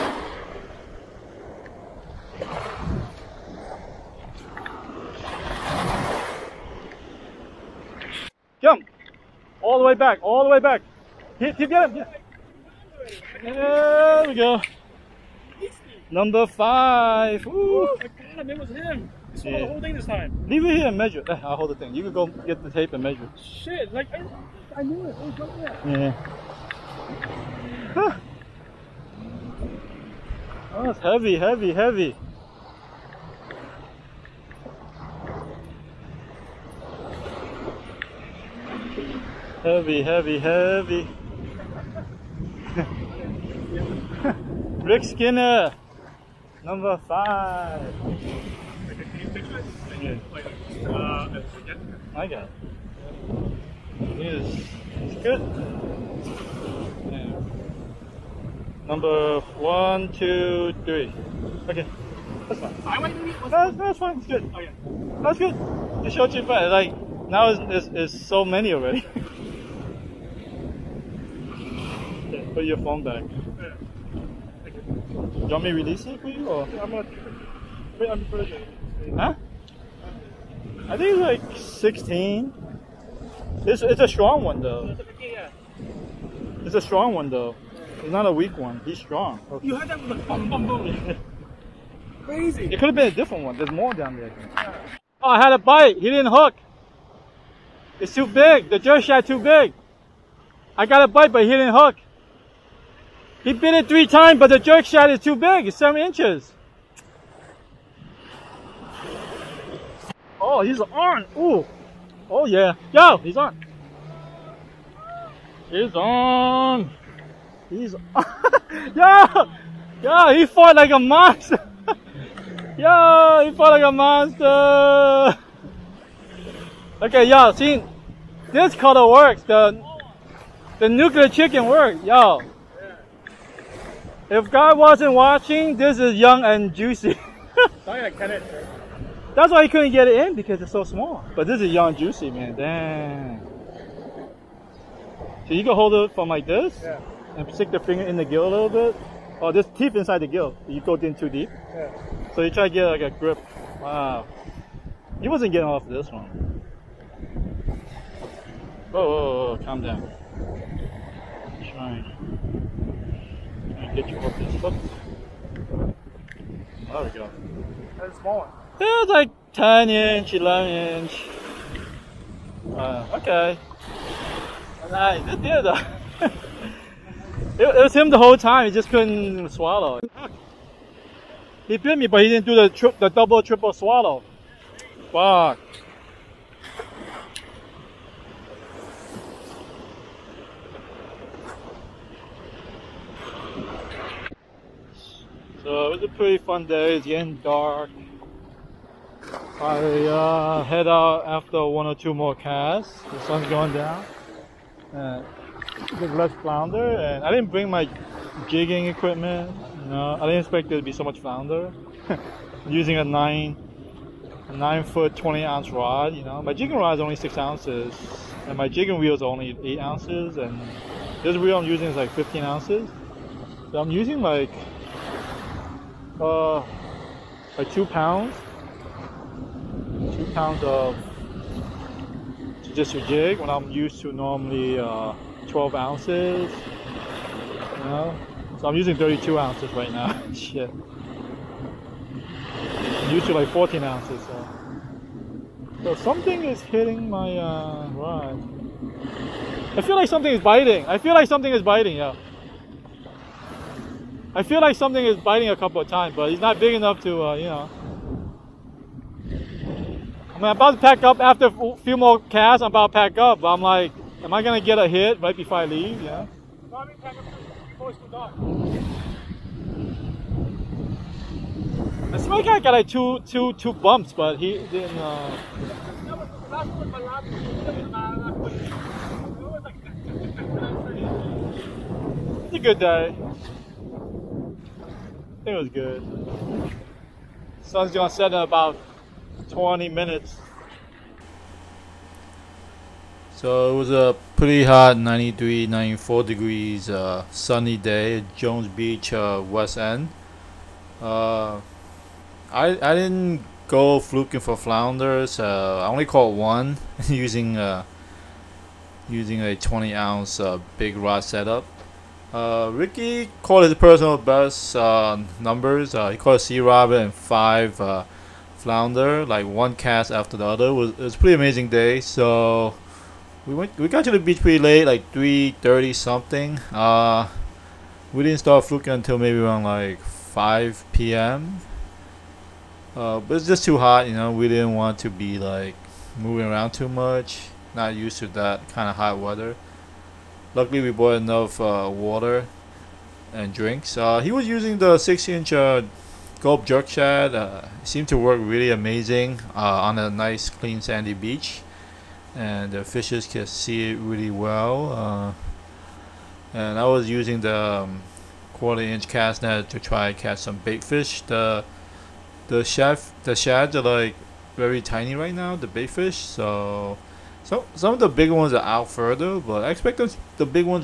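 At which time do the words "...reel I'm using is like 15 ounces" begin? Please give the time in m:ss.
3:41.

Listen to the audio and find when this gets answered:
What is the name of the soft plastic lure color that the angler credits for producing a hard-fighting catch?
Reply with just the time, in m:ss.
2:10.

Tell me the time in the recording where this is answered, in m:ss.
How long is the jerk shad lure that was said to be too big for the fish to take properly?
1:45.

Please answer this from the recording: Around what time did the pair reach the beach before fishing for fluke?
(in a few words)
3:30.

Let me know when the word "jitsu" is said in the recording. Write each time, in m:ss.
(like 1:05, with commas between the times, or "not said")
3:52.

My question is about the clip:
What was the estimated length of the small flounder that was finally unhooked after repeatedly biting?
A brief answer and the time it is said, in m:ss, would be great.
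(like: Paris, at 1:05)
10 inch, at 2:49.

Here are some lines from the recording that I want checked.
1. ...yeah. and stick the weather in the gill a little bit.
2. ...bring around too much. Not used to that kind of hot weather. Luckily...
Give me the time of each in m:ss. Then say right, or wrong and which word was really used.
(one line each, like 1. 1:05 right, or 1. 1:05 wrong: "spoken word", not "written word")
1. 2:26 wrong: "finger", not "weather"
2. 5:36 wrong: "moving", not "bring".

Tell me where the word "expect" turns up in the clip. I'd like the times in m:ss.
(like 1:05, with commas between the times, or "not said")
3:30, 6:09.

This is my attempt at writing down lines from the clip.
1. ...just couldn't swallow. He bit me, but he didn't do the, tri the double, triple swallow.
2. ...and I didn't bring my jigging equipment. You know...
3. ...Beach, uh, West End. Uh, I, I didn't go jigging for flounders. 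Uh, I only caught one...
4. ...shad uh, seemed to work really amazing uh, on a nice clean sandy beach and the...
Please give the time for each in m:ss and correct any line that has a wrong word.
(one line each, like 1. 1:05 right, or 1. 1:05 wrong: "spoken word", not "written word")
1. 2:58 right
2. 3:26 right
3. 4:58 wrong: "fluking", not "jigging"
4. 5:46 right.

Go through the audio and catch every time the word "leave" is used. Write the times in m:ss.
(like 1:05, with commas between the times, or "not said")
0:20, 4:25.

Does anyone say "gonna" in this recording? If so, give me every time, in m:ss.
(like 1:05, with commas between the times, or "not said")
1:16, 4:24, 4:47.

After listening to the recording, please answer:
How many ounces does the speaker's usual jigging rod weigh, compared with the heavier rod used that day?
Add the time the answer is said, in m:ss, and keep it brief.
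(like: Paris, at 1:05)
6 ounces, at 3:37.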